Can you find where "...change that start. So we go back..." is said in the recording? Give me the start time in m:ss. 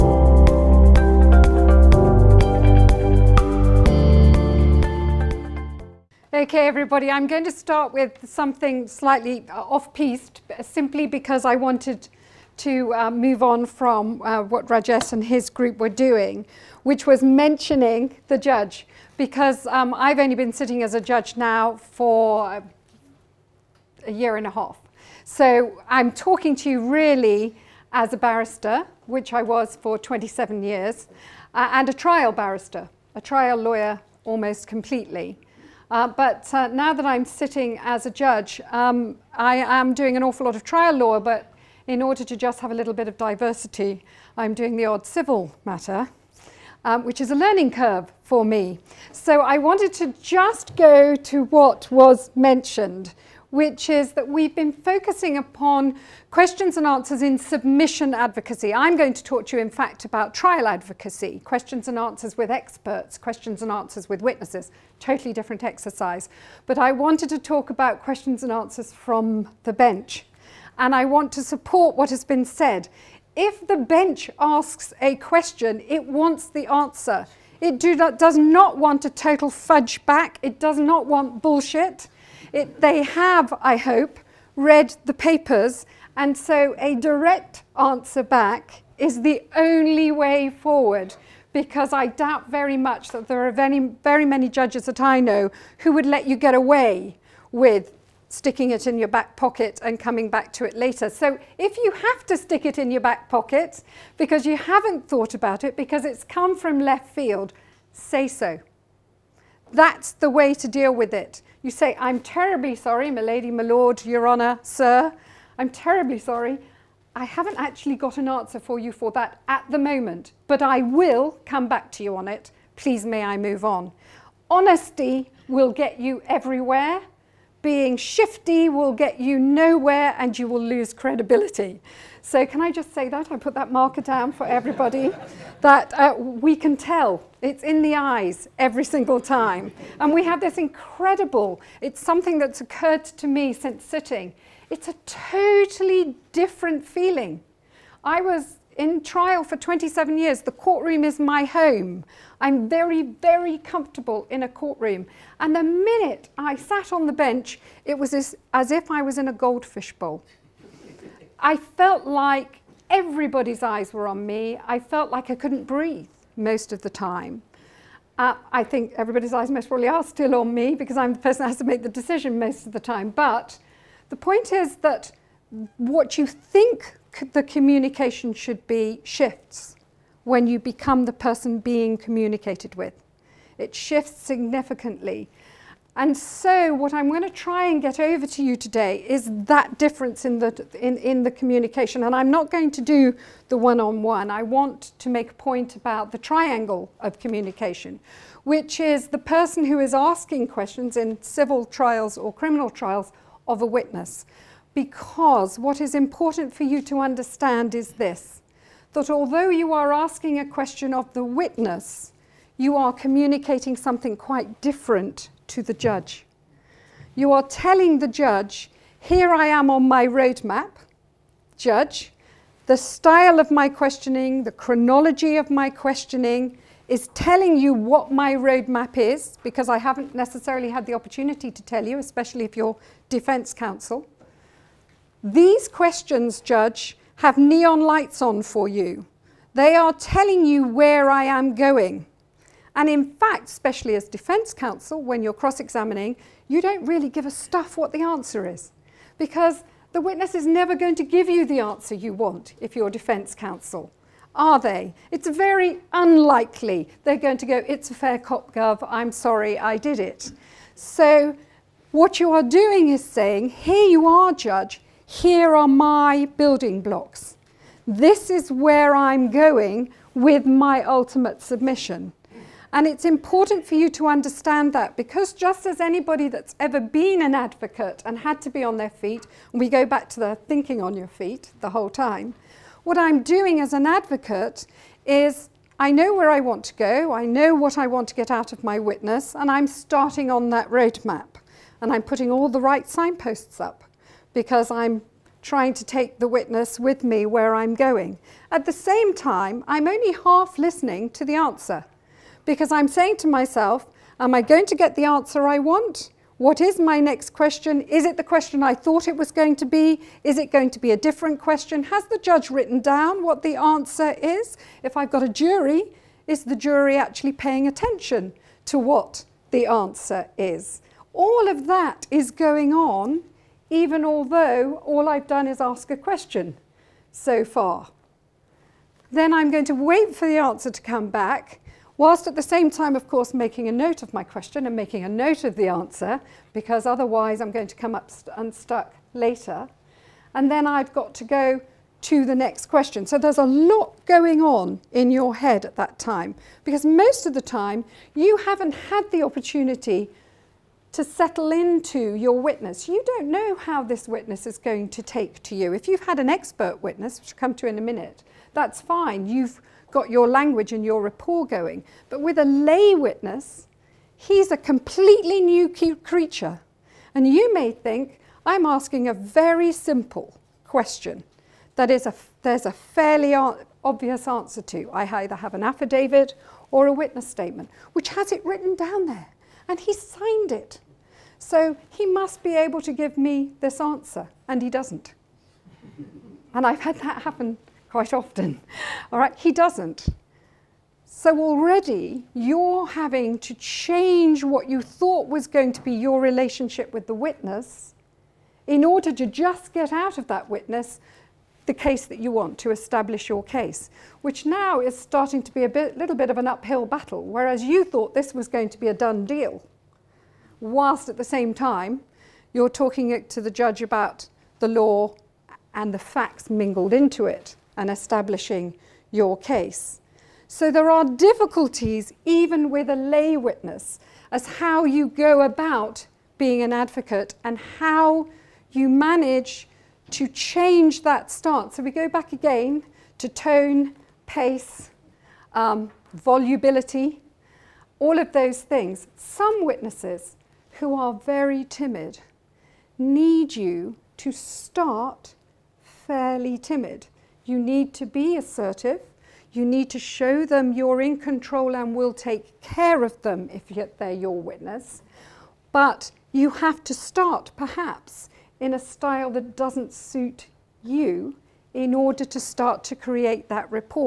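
7:10.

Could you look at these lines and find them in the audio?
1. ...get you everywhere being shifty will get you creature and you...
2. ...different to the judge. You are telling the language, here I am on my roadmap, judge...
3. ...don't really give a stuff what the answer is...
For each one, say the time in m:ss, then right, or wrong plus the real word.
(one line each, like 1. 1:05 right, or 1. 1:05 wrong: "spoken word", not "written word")
1. 2:05 wrong: "nowhere", not "creature"
2. 3:34 wrong: "judge", not "language"
3. 4:06 right.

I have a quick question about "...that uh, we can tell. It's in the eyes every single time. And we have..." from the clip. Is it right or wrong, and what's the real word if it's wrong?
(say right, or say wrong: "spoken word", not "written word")
right.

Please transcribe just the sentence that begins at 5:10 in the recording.
Is it going to be a different question?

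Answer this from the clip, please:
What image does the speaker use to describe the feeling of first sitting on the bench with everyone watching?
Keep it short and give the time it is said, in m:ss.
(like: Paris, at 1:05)
goldfish bowl, at 2:39.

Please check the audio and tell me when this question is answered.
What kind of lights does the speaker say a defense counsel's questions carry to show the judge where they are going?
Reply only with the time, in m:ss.
3:57.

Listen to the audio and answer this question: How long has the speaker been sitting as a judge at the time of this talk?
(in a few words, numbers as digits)
a year and a half.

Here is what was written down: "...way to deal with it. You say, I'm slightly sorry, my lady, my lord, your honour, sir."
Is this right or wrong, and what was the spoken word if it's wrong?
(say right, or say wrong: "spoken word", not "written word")
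wrong: "terribly", not "slightly".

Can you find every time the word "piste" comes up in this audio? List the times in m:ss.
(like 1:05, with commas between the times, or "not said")
0:09.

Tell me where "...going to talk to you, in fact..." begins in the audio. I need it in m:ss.
0:58.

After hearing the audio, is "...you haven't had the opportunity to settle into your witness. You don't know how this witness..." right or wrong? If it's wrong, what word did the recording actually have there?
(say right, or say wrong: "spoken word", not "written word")
right.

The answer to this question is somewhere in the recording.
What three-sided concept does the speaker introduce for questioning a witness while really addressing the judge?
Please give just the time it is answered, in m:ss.
3:16.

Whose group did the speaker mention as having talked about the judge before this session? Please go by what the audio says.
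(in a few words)
Rajesh.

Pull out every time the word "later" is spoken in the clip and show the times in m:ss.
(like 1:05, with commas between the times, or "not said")
1:40, 5:39.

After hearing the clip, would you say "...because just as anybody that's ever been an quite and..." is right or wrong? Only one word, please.
wrong.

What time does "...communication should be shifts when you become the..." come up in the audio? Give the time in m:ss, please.
2:57.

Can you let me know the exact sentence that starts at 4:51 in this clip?
And I'm putting all the right signposts up because I'm trying to take the witness with me where I'm going.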